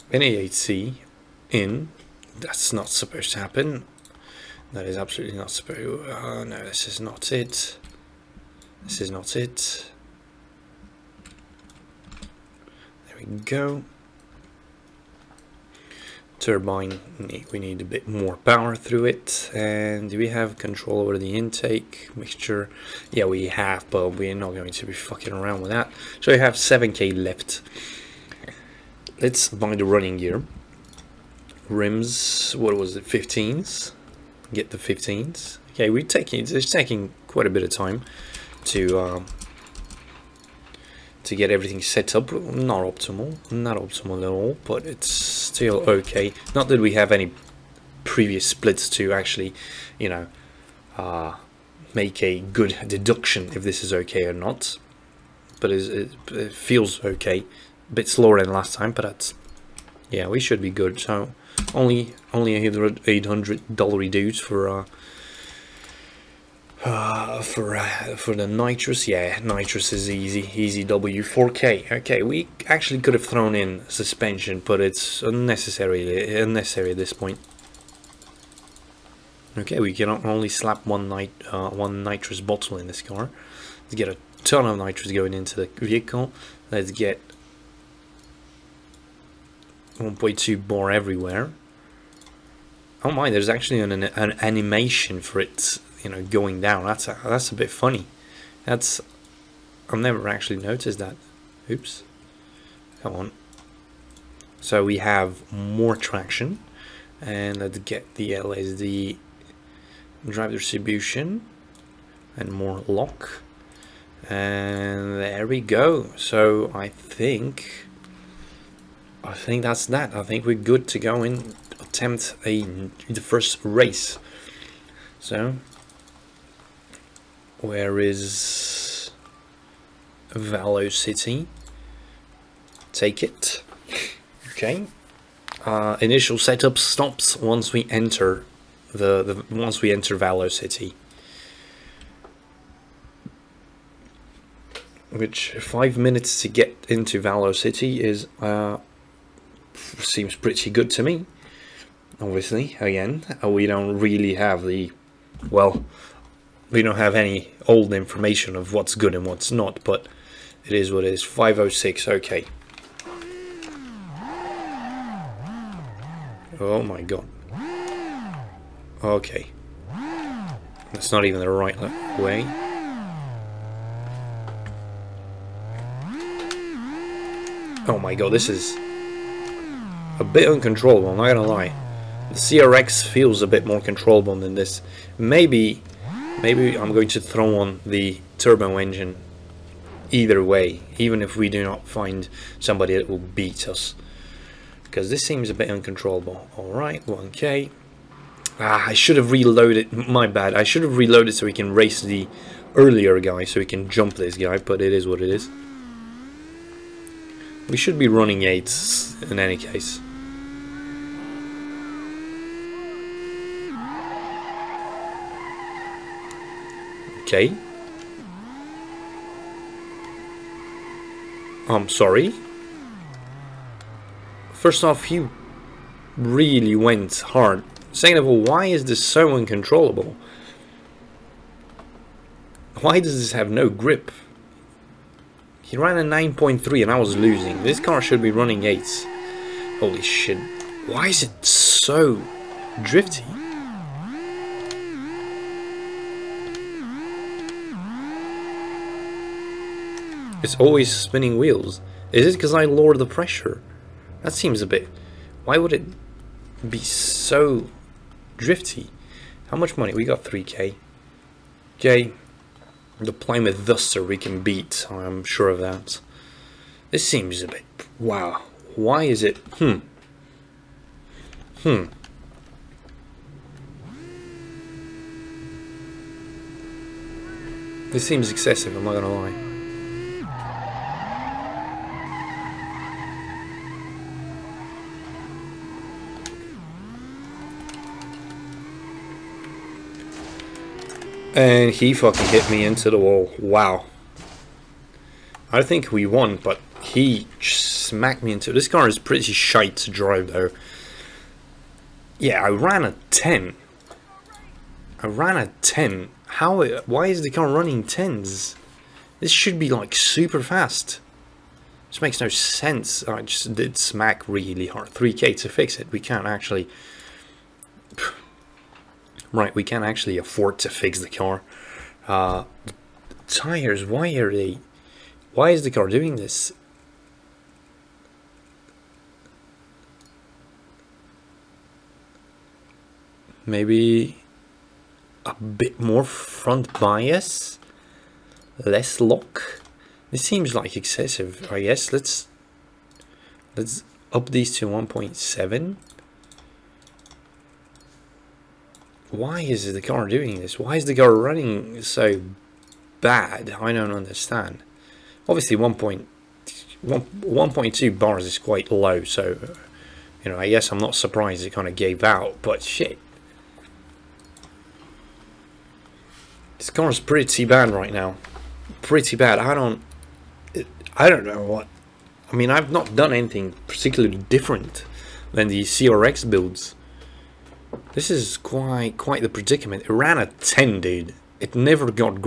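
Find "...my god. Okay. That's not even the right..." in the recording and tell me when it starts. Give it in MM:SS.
02:46.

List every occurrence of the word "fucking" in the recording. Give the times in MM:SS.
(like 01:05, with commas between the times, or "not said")
00:24, 04:51.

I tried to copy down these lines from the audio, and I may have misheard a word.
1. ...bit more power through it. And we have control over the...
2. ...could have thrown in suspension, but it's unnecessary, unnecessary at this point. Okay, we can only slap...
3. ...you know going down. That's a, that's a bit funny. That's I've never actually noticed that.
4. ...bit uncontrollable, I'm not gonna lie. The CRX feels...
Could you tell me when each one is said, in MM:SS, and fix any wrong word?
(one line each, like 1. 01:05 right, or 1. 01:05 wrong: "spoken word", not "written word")
1. 00:17 right
2. 01:12 right
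3. 01:36 right
4. 03:00 right.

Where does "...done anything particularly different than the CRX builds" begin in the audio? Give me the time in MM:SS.
06:12.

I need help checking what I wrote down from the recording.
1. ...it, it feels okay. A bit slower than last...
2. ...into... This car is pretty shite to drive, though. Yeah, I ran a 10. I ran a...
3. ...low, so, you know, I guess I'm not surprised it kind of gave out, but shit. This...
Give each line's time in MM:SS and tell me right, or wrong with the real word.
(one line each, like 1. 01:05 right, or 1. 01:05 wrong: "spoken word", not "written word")
1. 00:55 right
2. 04:58 right
3. 05:58 right.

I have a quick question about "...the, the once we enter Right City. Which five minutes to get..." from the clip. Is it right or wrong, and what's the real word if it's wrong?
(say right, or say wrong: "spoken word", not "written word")
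wrong: "Valo", not "Right".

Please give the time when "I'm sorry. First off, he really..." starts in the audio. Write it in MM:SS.
03:41.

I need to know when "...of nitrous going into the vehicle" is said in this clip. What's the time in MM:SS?
01:24.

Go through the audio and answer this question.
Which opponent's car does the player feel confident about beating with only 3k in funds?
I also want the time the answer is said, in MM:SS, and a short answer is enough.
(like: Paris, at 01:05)
Plymouth Duster, at 04:23.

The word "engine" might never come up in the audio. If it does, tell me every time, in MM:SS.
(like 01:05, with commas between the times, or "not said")
03:08.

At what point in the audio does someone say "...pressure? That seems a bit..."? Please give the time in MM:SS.
04:13.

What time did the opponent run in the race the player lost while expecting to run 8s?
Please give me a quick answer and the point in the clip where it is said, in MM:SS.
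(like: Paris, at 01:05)
9.3, at 03:56.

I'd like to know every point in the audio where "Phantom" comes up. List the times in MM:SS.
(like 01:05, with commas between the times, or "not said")
not said.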